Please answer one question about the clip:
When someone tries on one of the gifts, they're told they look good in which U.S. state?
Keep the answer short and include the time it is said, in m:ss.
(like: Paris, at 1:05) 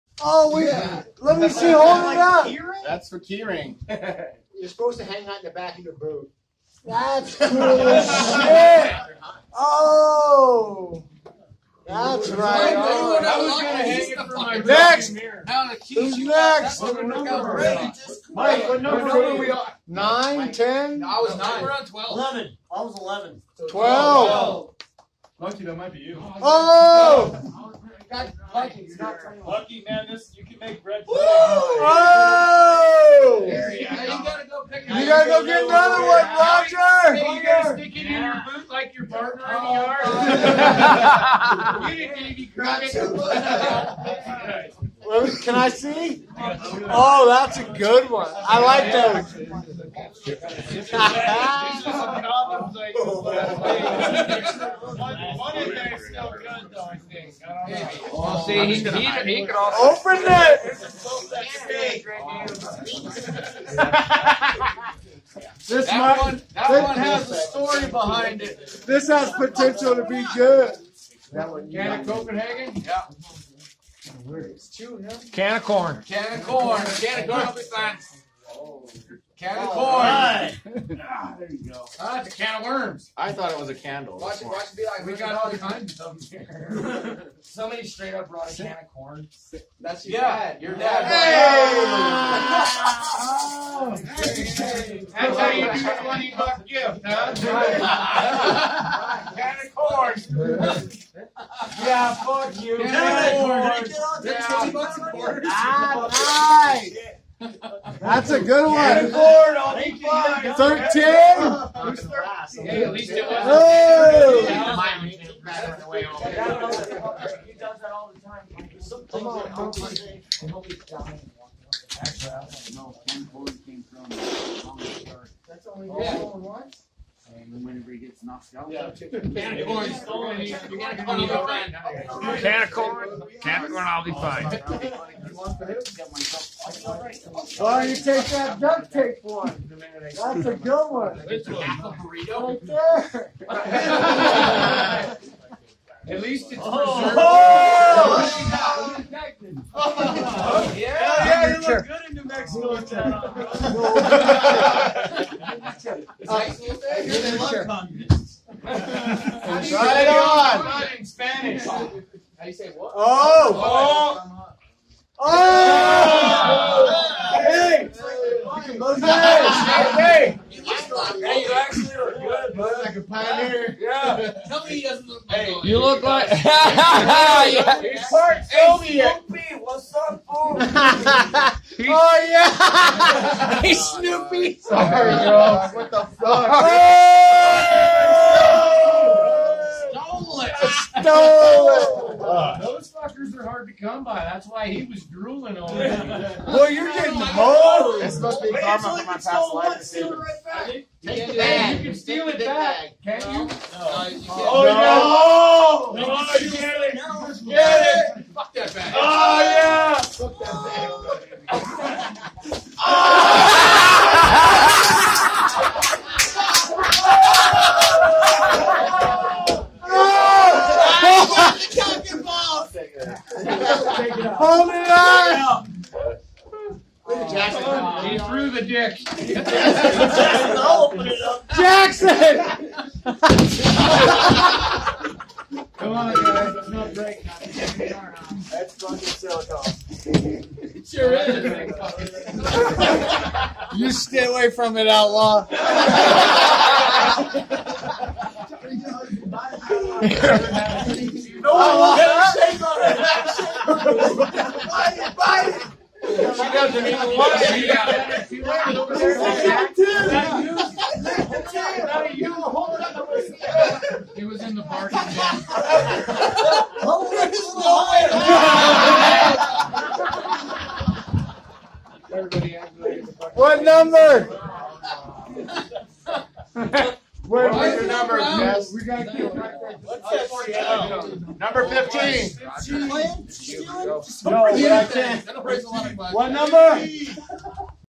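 New Mexico, at 2:32.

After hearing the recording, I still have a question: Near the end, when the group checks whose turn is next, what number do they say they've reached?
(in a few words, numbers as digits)
15.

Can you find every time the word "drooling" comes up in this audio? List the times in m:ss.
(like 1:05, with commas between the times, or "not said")
3:15.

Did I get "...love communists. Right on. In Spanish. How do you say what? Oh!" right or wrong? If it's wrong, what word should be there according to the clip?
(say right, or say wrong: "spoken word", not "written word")
right.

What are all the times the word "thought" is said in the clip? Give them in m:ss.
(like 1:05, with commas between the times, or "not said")
1:23.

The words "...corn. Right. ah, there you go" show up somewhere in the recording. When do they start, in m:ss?
1:19.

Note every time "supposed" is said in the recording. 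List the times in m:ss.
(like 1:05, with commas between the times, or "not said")
0:04, 3:18.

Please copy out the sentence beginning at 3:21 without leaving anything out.
You can steal it back, can't you?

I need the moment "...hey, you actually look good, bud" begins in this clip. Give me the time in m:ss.
2:50.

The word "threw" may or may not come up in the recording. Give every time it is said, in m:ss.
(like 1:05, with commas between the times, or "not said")
3:48.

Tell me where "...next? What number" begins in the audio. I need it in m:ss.
0:16.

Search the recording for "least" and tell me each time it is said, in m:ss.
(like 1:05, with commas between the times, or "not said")
1:52, 2:26.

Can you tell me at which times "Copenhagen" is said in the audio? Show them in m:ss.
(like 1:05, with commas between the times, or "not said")
1:12.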